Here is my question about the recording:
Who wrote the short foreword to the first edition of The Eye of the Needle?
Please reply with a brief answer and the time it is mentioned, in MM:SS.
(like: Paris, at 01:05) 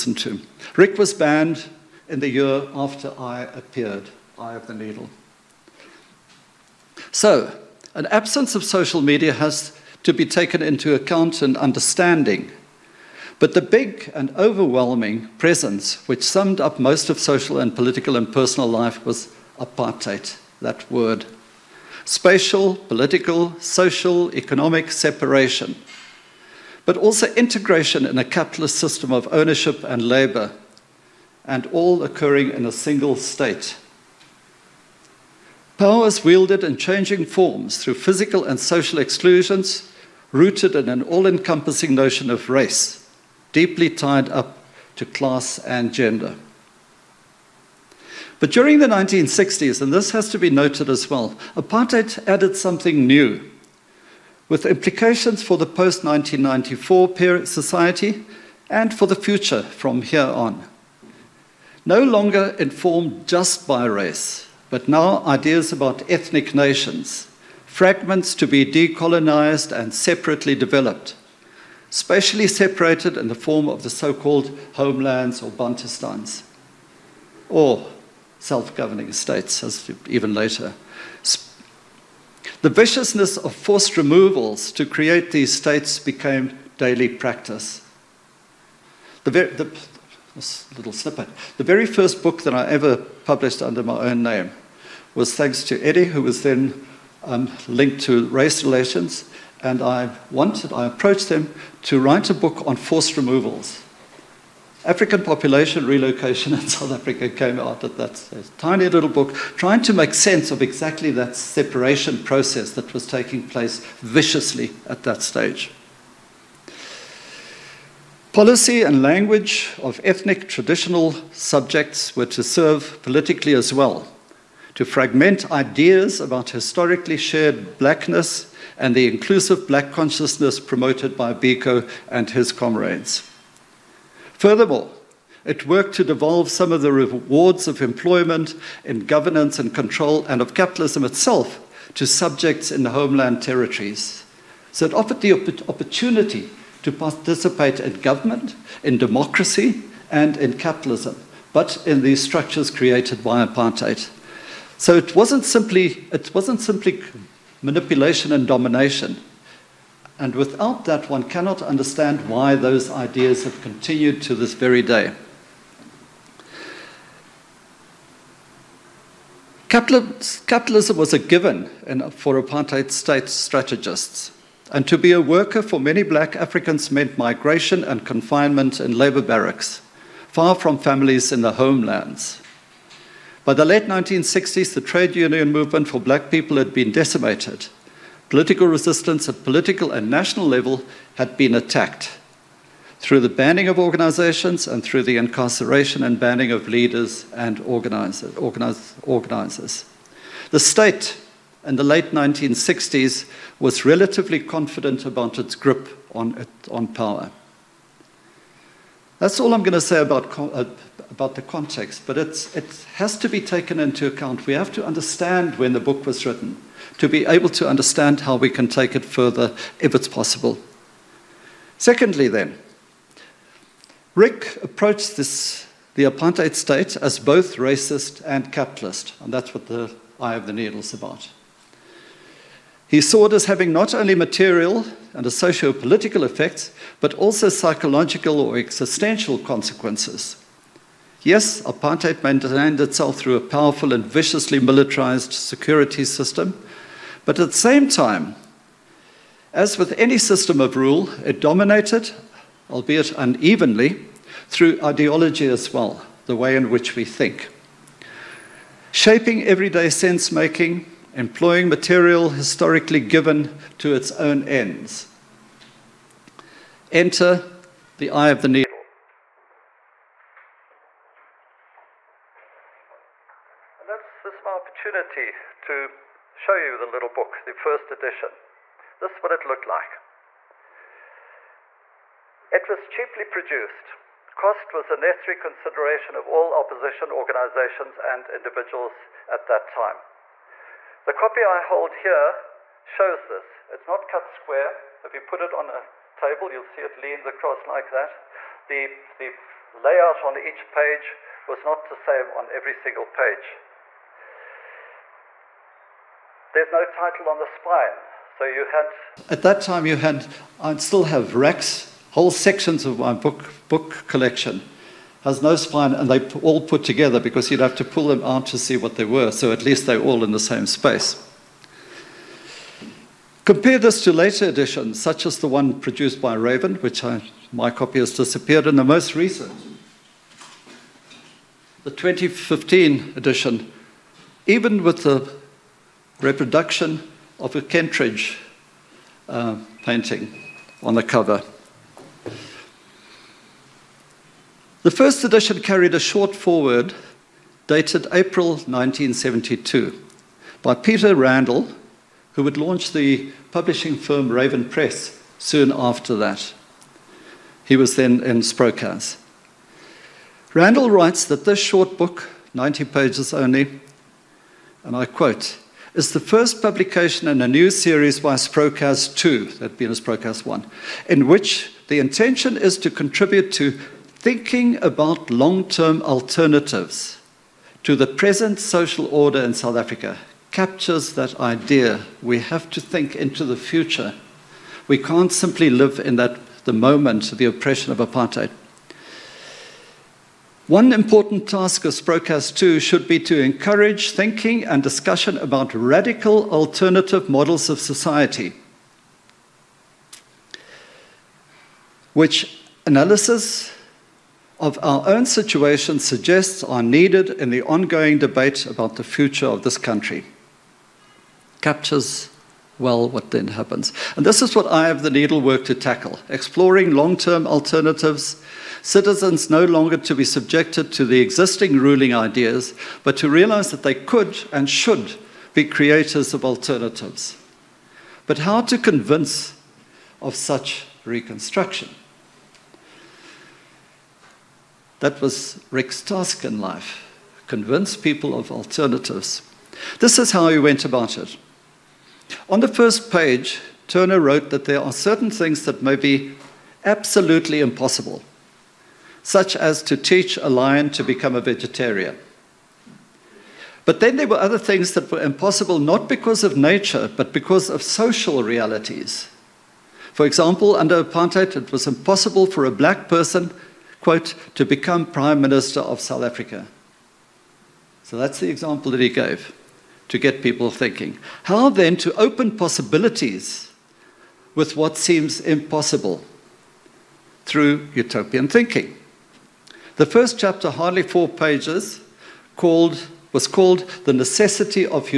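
Peter Randall, at 05:50.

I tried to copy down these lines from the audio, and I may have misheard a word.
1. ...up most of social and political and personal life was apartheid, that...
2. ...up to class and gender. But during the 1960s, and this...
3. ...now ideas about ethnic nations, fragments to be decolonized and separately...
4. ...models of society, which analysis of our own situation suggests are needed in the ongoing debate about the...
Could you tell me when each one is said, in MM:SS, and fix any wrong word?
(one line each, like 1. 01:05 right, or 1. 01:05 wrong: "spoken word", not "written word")
1. 00:16 right
2. 00:44 right
3. 01:04 right
4. 06:37 right.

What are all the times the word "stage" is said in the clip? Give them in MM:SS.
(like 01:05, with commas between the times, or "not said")
01:48, 01:55.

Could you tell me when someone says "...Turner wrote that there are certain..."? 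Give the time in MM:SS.
07:23.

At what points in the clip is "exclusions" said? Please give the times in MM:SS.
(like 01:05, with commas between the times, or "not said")
00:38.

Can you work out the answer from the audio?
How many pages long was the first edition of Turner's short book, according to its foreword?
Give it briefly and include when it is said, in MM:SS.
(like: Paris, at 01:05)
90, at 06:02.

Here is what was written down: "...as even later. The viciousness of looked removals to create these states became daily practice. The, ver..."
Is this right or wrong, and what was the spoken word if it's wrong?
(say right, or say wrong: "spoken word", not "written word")
wrong: "forced", not "looked".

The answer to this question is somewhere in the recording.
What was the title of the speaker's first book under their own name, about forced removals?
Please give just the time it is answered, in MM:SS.
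01:44.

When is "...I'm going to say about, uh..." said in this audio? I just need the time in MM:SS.
03:29.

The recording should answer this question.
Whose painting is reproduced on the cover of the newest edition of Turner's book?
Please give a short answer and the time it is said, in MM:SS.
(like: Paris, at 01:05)
Kentridge, at 05:37.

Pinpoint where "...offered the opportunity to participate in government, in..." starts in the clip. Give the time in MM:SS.
02:24.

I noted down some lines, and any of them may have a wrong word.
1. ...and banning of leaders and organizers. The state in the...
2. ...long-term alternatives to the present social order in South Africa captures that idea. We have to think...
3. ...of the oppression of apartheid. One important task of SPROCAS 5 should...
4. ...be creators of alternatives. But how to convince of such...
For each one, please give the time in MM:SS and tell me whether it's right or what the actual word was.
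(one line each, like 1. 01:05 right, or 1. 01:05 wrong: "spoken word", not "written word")
1. 03:16 right
2. 06:15 right
3. 06:27 wrong: "2", not "5"
4. 07:05 right.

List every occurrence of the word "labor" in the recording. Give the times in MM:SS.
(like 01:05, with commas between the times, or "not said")
00:30, 02:58.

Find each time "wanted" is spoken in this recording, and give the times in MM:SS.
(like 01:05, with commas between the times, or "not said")
01:40.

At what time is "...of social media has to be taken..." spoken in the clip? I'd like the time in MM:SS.
00:08.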